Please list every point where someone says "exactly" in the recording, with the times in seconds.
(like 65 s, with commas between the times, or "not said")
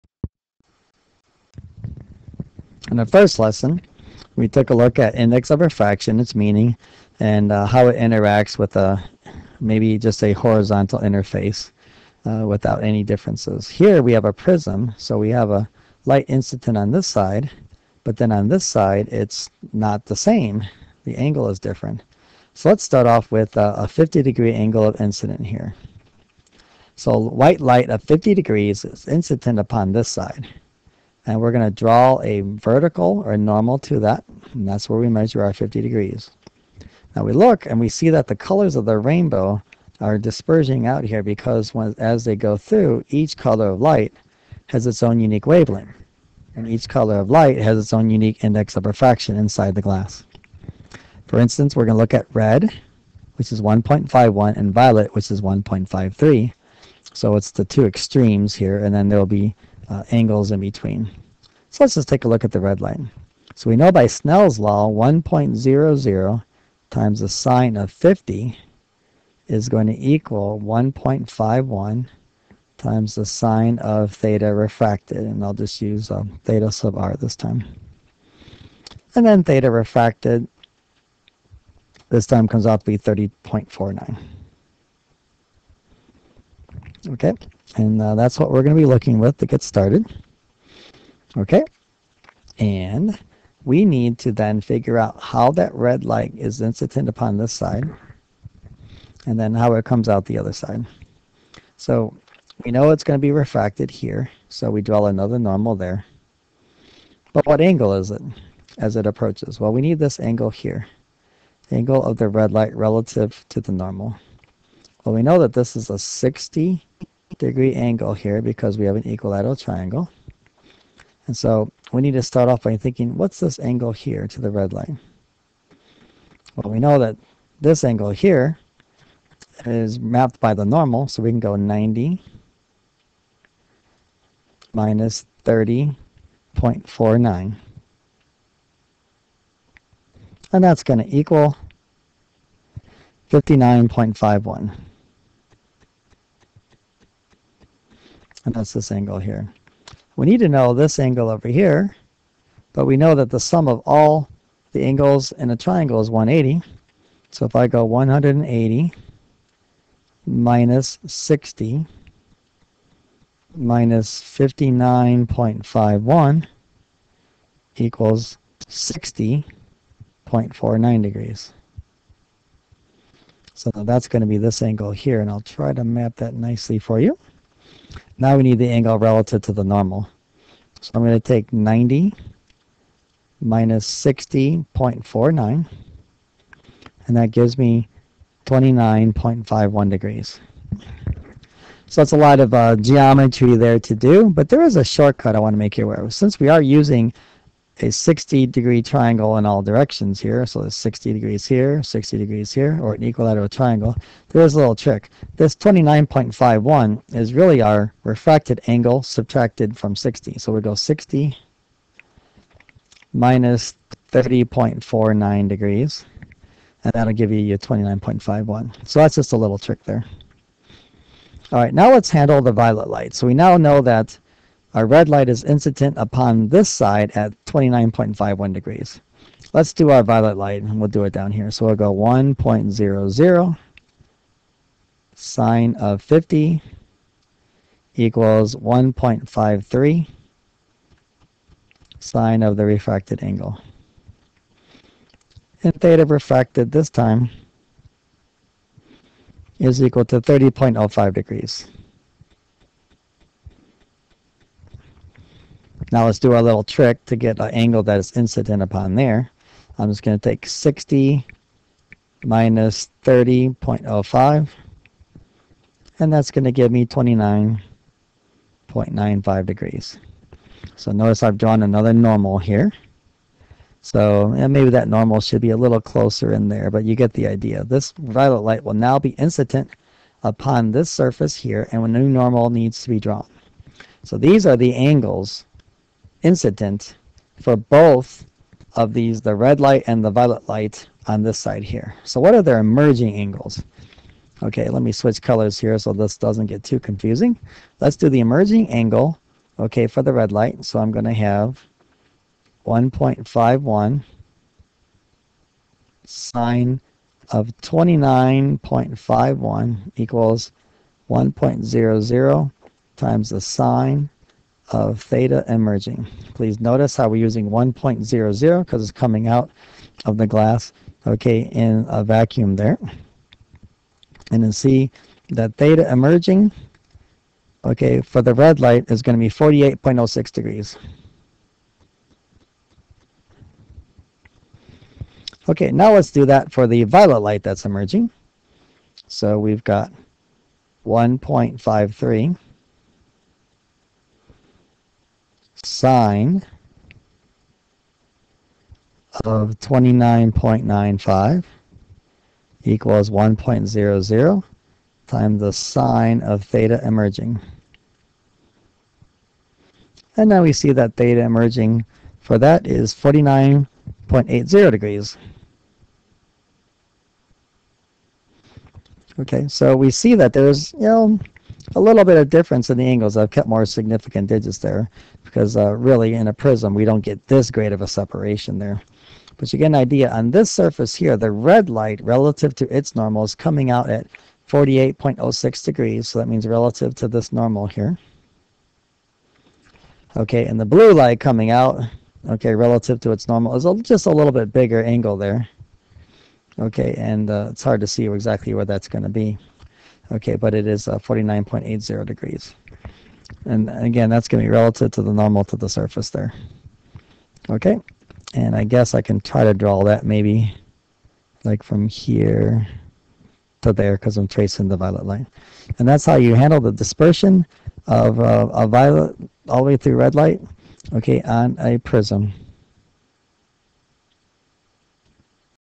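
398 s.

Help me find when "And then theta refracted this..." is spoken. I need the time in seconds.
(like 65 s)
79 s.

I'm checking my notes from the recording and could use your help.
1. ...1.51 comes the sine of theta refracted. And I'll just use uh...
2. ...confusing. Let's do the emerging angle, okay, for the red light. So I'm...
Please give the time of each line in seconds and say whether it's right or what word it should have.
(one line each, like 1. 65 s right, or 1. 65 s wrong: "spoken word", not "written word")
1. 70 s wrong: "times", not "comes"
2. 296 s right.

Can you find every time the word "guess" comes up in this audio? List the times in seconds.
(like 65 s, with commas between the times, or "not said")
408 s.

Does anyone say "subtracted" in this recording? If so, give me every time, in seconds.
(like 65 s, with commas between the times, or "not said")
209 s.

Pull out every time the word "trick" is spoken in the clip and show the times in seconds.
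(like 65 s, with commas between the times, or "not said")
204 s, 219 s, 256 s.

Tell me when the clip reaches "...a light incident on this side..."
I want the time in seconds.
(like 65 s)
15 s.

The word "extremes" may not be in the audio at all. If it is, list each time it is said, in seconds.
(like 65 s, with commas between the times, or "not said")
57 s.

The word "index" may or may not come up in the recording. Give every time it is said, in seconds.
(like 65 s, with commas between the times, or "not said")
5 s, 48 s.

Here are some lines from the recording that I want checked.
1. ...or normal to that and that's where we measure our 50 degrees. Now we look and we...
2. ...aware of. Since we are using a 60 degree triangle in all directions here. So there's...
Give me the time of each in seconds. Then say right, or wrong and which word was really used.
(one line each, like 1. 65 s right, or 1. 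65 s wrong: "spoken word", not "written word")
1. 33 s right
2. 195 s right.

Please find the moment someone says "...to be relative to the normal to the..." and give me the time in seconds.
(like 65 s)
404 s.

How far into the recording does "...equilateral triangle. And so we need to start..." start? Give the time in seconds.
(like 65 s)
119 s.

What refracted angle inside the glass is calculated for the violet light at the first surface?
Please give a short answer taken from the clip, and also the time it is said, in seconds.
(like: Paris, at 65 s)
30.05 degrees, at 250 s.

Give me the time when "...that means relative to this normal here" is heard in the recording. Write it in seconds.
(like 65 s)
386 s.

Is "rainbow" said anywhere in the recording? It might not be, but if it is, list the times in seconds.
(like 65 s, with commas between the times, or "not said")
38 s.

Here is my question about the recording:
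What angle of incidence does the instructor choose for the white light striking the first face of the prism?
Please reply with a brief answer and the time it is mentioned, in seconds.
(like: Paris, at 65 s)
50 degrees, at 23 s.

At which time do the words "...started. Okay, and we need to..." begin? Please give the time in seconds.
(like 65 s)
89 s.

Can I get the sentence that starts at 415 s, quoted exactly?
And that's how you handle the dispersion of uh, a violet all the way through red light, okay, on a prism.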